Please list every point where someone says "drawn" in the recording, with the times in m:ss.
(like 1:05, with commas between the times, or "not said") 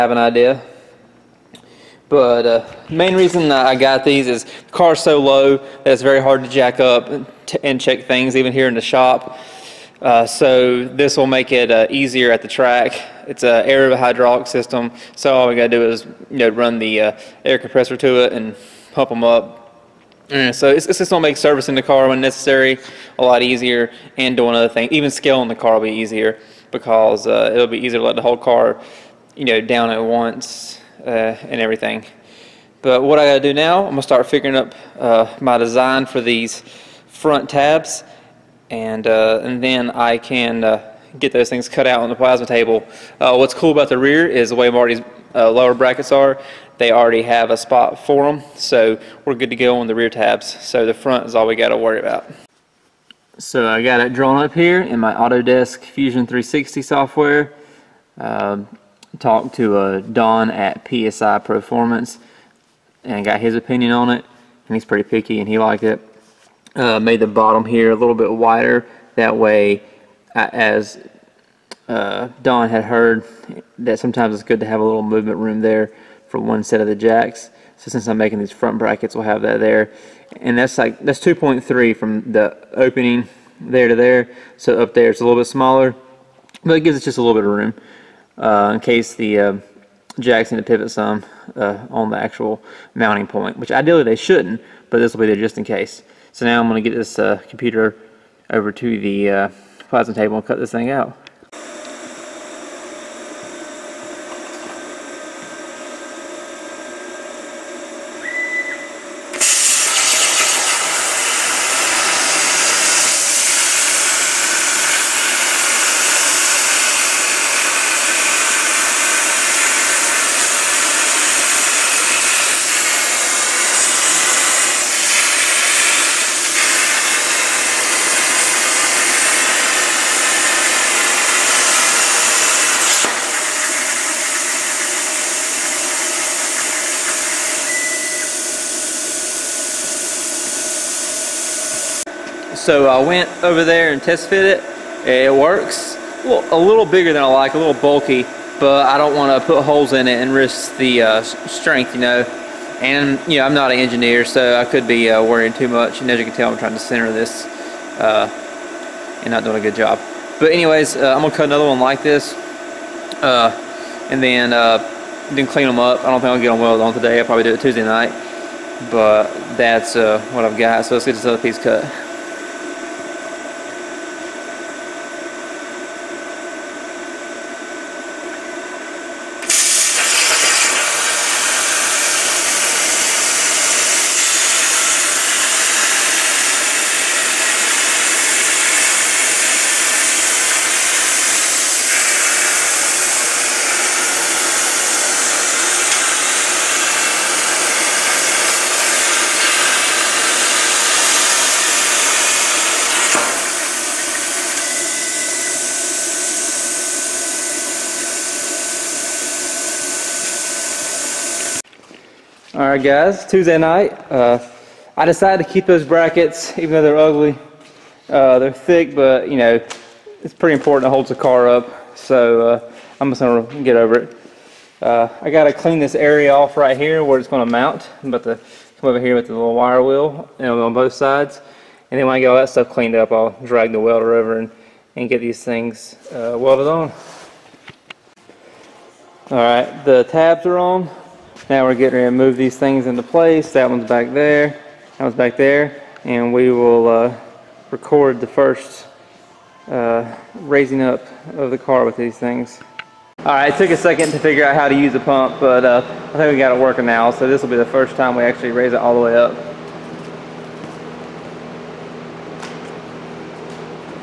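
0:54.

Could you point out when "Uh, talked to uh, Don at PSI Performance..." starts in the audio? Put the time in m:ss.
0:58.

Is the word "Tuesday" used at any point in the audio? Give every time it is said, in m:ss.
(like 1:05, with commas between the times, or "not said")
2:47, 3:33.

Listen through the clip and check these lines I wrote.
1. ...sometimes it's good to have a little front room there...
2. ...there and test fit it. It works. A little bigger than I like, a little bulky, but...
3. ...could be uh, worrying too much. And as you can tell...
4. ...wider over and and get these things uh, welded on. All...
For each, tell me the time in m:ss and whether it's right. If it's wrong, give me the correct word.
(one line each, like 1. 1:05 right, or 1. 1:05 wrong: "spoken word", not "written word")
1. 1:13 wrong: "movement", not "front"
2. 2:23 right
3. 2:34 right
4. 3:53 wrong: "welder", not "wider".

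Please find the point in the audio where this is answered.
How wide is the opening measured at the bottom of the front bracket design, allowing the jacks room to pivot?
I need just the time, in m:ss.
1:21.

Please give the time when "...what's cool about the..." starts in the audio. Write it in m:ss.
0:43.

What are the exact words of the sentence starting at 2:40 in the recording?
But anyways, uh, I'm going to cut another one like this uh, and then uh, then clean them up.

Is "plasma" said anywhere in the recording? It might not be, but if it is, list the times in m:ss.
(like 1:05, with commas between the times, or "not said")
0:42, 1:39.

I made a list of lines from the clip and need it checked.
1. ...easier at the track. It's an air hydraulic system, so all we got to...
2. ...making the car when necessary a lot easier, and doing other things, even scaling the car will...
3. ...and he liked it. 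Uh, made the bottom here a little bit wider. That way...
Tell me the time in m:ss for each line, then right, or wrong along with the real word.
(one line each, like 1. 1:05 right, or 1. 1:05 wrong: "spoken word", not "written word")
1. 0:11 right
2. 0:21 wrong: "servicing", not "making"
3. 1:05 right.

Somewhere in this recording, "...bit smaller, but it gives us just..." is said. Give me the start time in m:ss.
1:25.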